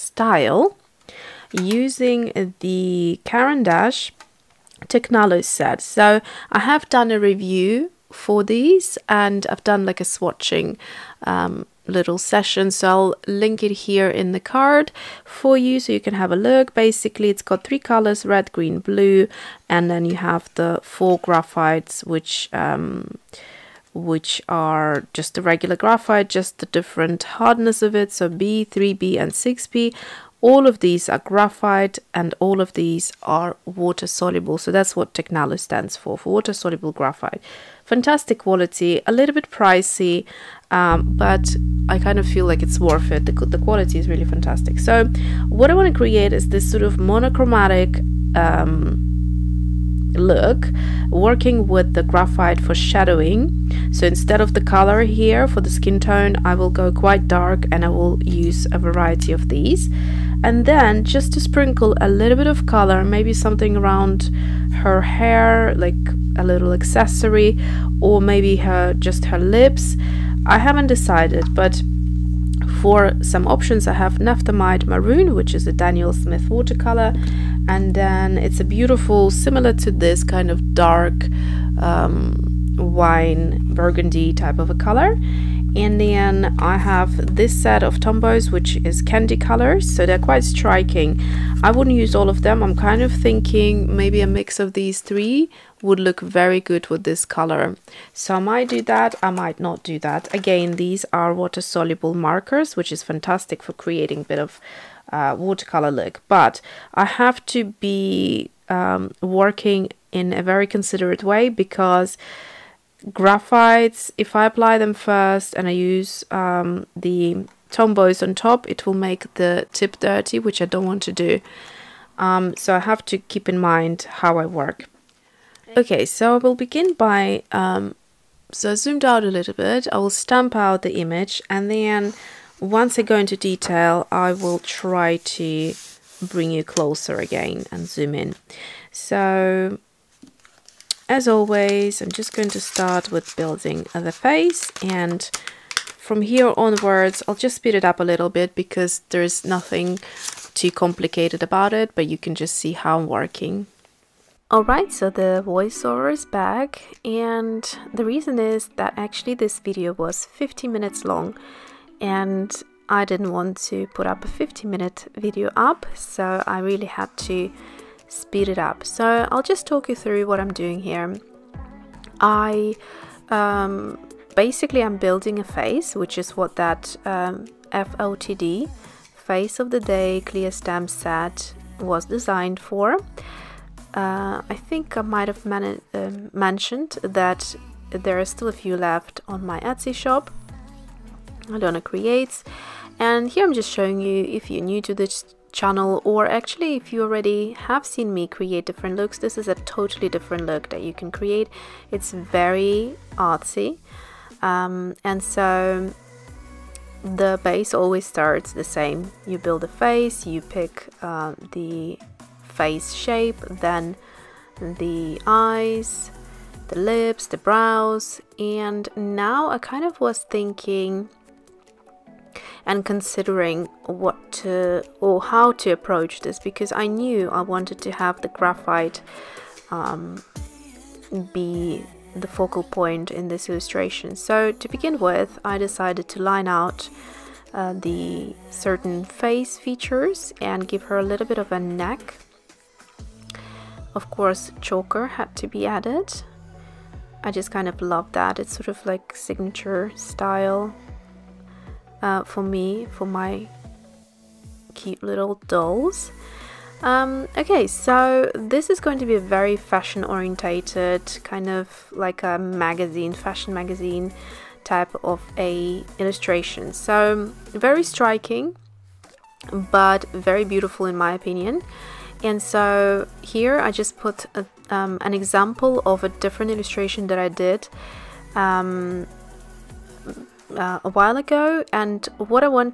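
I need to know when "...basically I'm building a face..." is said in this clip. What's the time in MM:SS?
02:54.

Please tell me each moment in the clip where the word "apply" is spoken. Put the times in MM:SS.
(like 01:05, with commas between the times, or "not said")
01:54.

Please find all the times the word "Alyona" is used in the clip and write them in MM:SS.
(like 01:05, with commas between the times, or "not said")
03:11.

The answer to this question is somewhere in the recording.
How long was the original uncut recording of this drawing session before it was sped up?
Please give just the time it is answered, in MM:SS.
02:40.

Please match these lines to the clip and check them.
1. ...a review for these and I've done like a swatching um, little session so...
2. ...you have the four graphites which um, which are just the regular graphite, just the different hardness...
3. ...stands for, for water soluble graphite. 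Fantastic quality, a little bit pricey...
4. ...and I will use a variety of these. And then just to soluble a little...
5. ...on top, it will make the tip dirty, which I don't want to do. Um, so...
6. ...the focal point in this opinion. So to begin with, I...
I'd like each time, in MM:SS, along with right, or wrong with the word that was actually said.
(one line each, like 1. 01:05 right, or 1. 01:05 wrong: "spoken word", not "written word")
1. 00:07 right
2. 00:20 right
3. 00:35 right
4. 00:57 wrong: "sprinkle", not "soluble"
5. 01:58 right
6. 03:52 wrong: "illustration", not "opinion".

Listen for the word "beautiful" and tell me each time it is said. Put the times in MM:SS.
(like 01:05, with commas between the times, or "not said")
01:18, 04:30.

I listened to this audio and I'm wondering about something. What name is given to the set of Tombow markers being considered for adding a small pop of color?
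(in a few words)
candy colors.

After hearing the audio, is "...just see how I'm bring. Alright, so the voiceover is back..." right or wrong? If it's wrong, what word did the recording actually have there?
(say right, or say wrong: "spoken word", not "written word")
wrong: "working", not "bring".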